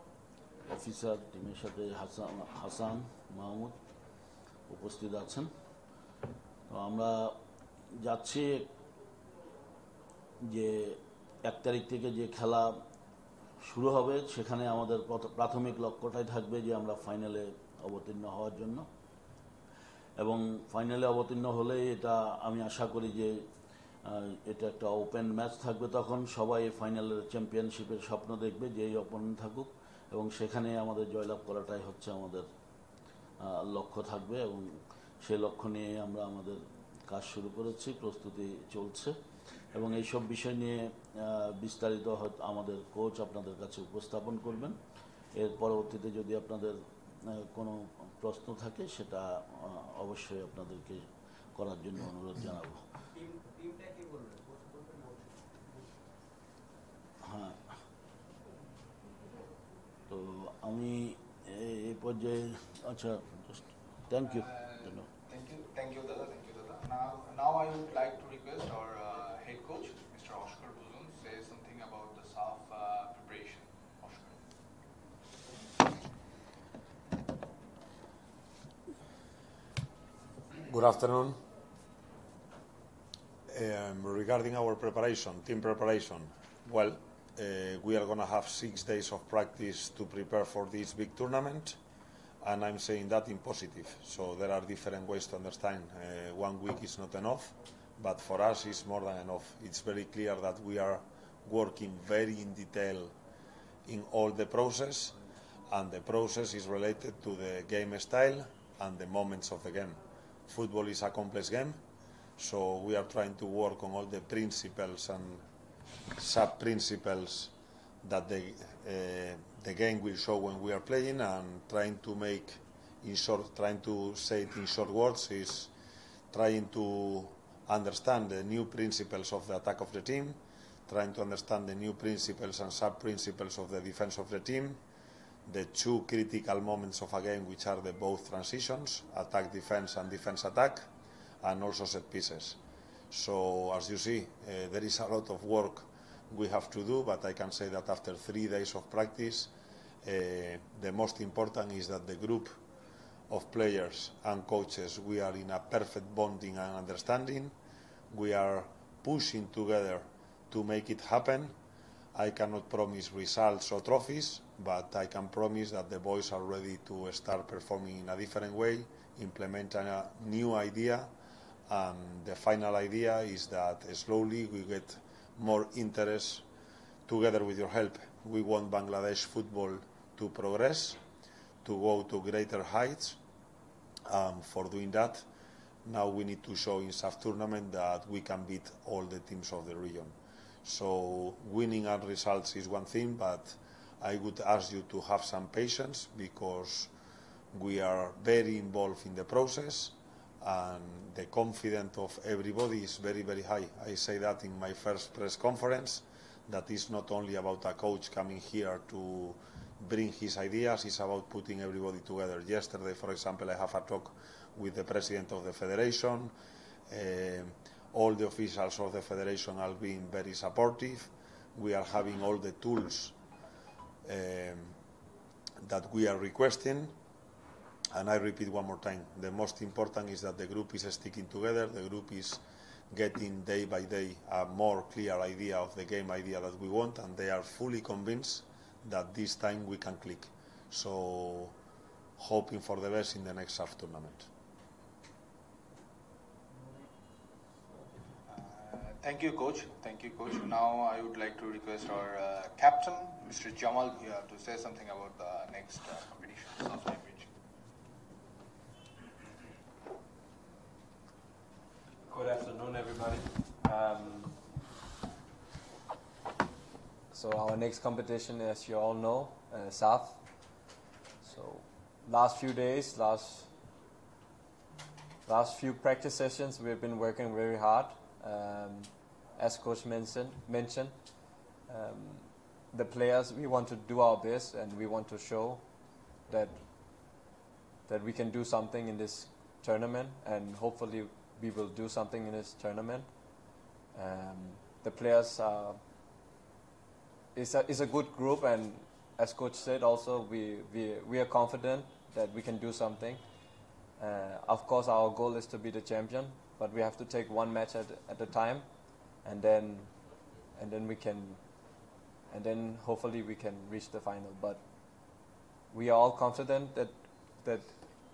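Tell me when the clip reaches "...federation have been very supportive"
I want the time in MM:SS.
03:39.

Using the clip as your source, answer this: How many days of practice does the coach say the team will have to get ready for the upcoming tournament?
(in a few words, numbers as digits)
6.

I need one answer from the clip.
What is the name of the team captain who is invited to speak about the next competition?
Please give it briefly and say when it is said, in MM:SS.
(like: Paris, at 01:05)
Jamal, at 04:13.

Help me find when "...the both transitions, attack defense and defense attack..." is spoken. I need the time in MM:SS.
02:17.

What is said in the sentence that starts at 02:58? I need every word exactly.
We want Bangladesh football to progress, to go to greater heights.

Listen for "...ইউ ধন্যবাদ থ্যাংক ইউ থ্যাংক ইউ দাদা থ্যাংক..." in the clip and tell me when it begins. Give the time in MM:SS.
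01:04.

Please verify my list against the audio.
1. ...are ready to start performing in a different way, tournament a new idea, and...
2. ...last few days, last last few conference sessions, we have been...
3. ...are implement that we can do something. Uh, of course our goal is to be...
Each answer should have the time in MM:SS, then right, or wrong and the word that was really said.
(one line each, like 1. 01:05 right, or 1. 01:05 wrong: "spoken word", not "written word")
1. 02:46 wrong: "implement", not "tournament"
2. 04:32 wrong: "practice", not "conference"
3. 05:01 wrong: "confident", not "implement".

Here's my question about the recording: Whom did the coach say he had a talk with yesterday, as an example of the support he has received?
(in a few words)
President of the federation.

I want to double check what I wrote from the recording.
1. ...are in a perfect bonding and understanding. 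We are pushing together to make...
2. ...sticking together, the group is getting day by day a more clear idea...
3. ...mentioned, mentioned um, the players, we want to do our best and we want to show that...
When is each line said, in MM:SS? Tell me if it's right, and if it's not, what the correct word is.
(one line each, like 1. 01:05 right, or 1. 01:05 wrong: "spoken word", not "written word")
1. 02:35 right
2. 03:50 right
3. 04:39 right.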